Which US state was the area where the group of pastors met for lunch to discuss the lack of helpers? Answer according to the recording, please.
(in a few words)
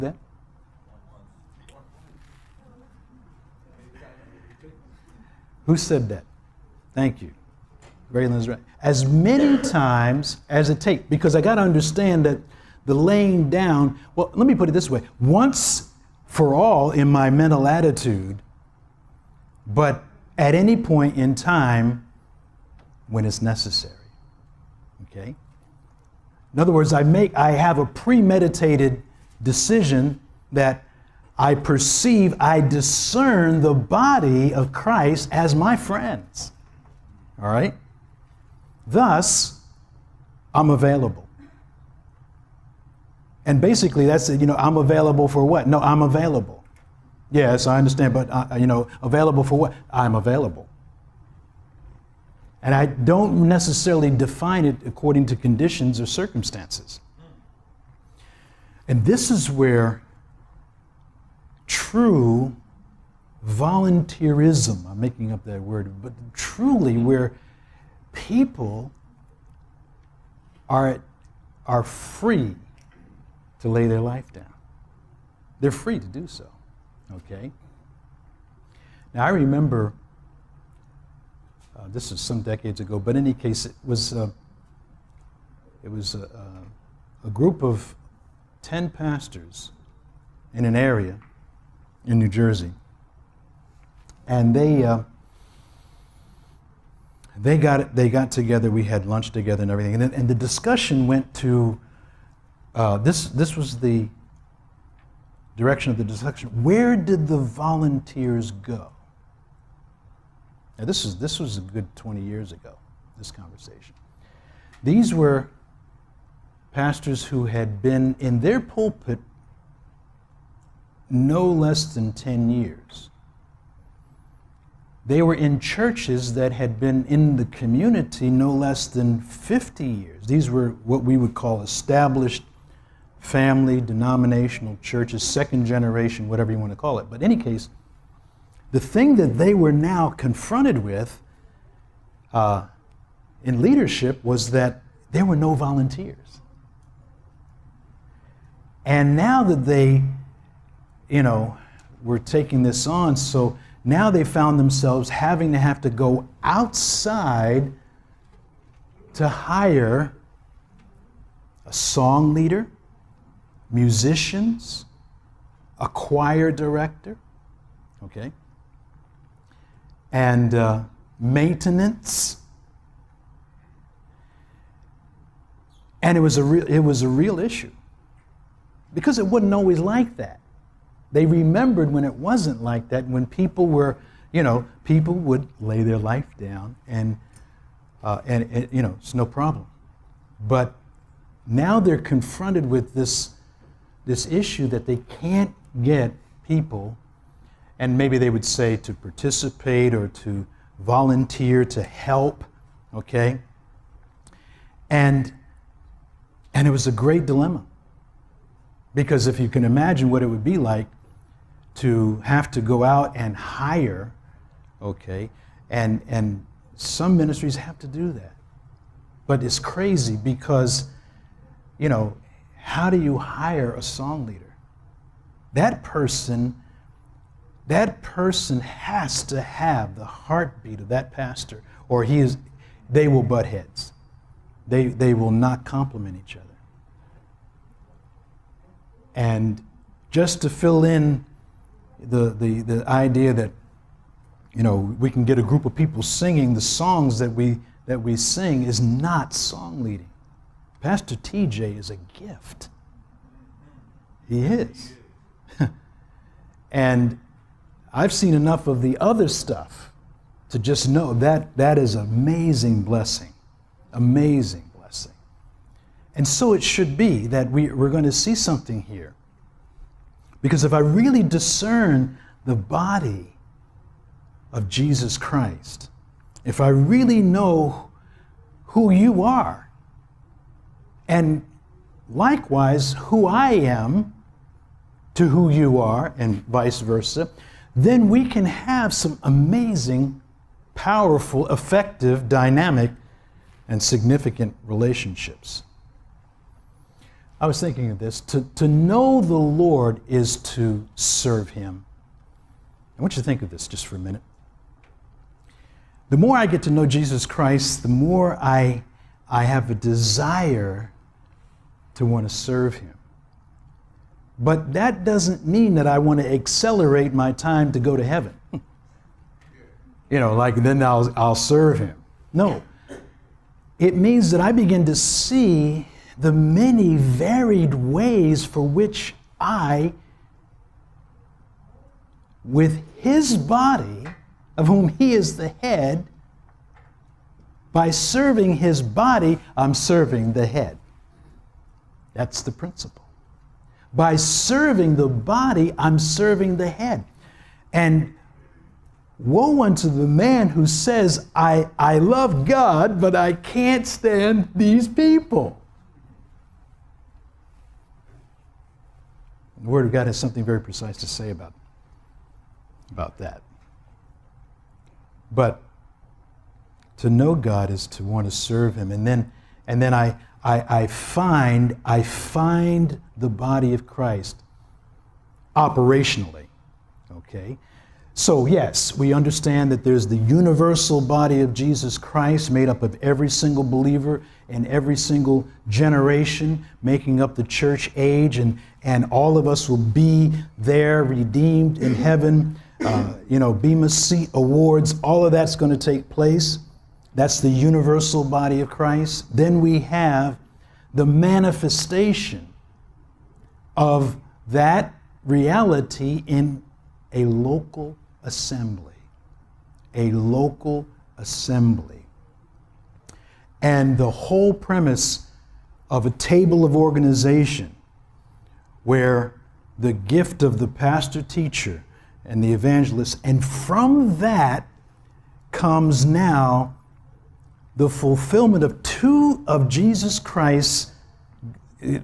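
New Jersey.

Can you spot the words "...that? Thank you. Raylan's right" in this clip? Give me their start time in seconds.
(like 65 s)
6 s.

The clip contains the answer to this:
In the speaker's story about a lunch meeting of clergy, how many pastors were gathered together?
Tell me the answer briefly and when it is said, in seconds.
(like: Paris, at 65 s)
10, at 88 s.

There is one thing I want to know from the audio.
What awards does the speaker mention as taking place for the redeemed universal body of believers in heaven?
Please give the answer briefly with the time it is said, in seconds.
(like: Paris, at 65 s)
Bema Seat Awards, at 393 s.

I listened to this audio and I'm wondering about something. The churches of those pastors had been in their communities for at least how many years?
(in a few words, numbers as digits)
50.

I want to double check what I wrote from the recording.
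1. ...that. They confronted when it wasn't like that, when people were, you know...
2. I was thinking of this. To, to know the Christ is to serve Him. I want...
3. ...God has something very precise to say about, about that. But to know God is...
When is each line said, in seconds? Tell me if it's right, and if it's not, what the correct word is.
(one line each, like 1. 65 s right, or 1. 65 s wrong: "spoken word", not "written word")
1. 180 s wrong: "remembered", not "confronted"
2. 297 s wrong: "Lord", not "Christ"
3. 359 s right.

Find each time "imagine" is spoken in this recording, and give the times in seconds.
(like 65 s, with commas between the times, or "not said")
209 s.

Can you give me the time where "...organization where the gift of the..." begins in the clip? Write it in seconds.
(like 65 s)
416 s.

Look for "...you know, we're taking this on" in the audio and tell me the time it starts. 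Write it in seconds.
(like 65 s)
151 s.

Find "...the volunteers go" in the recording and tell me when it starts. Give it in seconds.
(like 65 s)
107 s.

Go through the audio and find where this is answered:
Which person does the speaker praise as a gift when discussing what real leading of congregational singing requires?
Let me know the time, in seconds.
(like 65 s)
250 s.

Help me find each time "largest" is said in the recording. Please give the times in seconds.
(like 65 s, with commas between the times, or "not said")
not said.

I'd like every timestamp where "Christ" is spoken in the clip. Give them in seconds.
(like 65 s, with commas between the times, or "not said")
34 s, 275 s, 307 s, 373 s, 381 s, 398 s, 430 s.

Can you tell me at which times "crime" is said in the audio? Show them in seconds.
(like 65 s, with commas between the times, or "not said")
not said.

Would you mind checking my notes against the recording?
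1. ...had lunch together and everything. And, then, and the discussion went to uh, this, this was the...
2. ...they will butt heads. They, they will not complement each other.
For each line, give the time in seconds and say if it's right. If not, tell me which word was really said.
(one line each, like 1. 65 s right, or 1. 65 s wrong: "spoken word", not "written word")
1. 98 s right
2. 232 s right.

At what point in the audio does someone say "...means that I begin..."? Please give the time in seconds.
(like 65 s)
323 s.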